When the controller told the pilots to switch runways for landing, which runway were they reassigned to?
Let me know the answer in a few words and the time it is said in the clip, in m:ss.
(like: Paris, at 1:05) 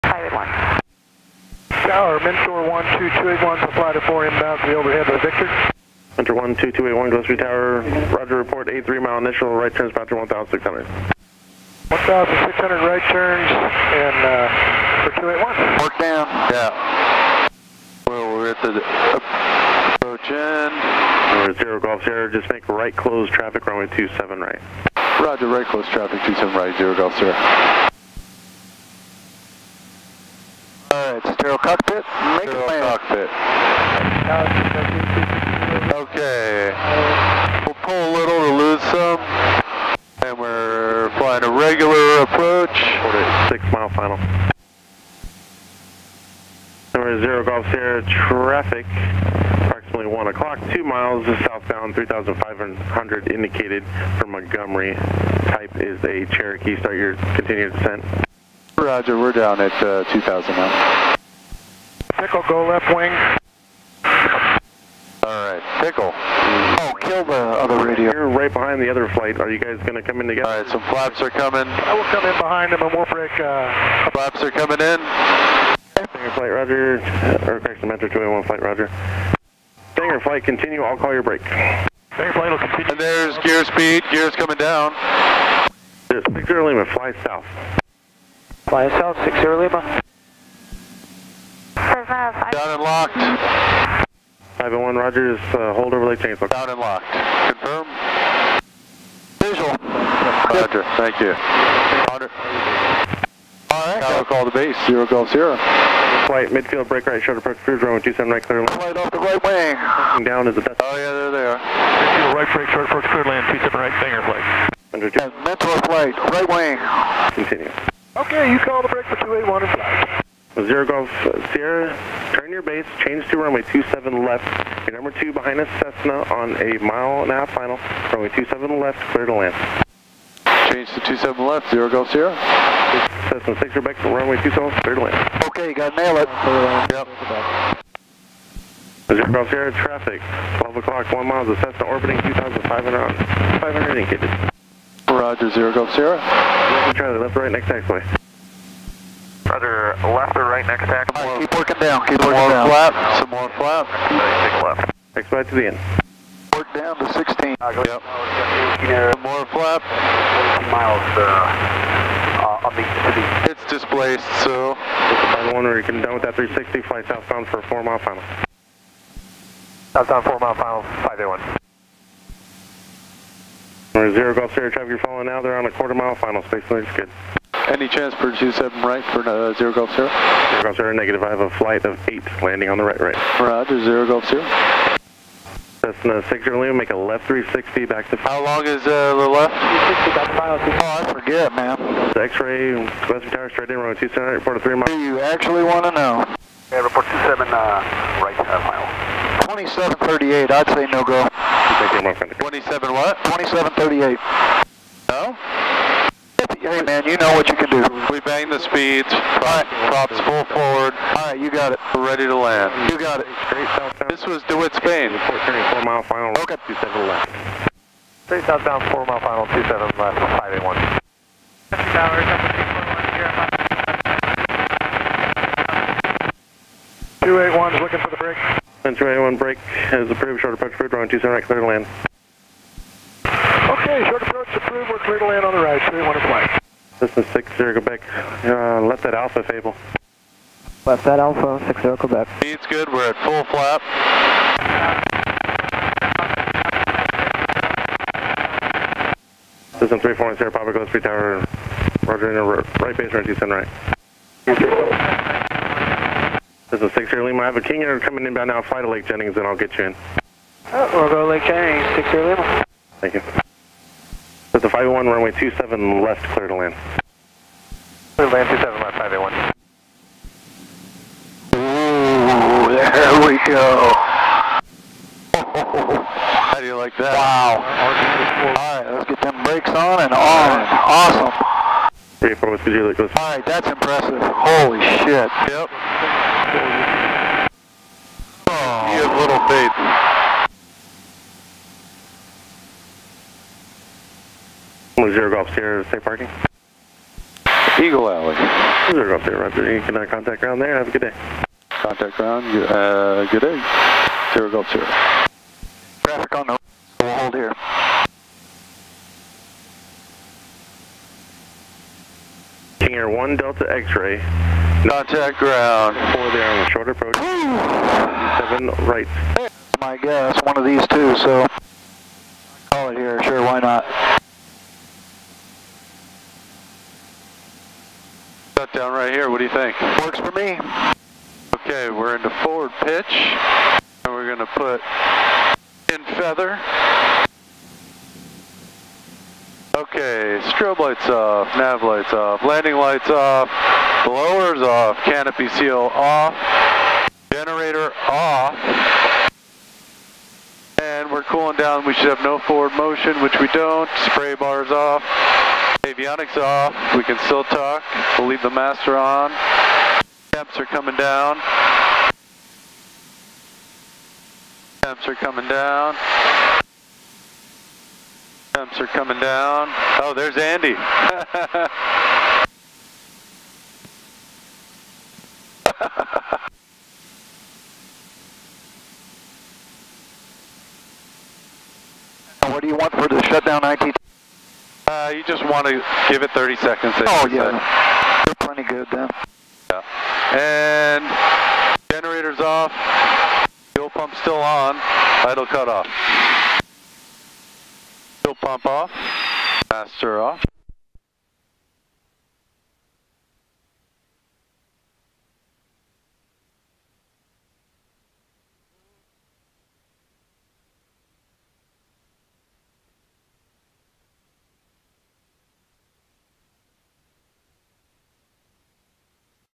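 27 left, at 2:03.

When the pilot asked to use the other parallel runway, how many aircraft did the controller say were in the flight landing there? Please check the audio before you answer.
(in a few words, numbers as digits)
8.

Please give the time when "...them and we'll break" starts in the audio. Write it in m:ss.
1:12.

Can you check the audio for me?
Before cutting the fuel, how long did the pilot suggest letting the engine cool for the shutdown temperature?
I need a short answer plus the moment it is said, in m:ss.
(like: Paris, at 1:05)
30 seconds, at 6:26.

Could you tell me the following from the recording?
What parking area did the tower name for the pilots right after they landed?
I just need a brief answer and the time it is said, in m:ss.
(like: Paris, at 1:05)
Eagle Alley, at 4:57.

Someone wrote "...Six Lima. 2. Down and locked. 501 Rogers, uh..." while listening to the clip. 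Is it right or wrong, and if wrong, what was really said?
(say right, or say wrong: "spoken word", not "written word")
wrong: "5", not "2".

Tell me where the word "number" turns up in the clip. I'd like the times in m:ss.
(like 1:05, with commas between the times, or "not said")
0:46, 2:05.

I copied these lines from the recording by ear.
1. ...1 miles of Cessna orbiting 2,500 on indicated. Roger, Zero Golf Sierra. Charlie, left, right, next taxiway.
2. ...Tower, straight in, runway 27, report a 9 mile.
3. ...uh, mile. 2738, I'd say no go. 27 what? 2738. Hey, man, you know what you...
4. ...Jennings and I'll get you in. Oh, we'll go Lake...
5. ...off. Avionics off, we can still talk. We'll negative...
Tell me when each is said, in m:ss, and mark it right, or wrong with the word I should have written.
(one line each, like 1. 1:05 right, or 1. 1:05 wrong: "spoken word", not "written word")
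1. 2:21 right
2. 3:13 wrong: "3", not "9"
3. 3:18 right
4. 4:19 right
5. 5:54 wrong: "leave", not "negative".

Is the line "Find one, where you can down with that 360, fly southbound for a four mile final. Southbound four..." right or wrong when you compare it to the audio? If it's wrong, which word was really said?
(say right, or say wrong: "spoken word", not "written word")
right.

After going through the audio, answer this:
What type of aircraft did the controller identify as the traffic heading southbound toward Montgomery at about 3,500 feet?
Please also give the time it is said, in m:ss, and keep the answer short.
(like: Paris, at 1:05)
Cherokee, at 0:54.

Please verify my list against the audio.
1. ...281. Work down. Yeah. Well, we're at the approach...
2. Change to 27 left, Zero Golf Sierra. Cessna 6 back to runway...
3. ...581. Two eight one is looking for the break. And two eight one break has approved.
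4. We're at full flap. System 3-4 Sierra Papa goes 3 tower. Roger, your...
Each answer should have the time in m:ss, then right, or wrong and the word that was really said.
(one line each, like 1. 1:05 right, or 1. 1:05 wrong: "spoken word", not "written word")
1. 0:15 right
2. 2:10 right
3. 3:41 right
4. 4:02 right.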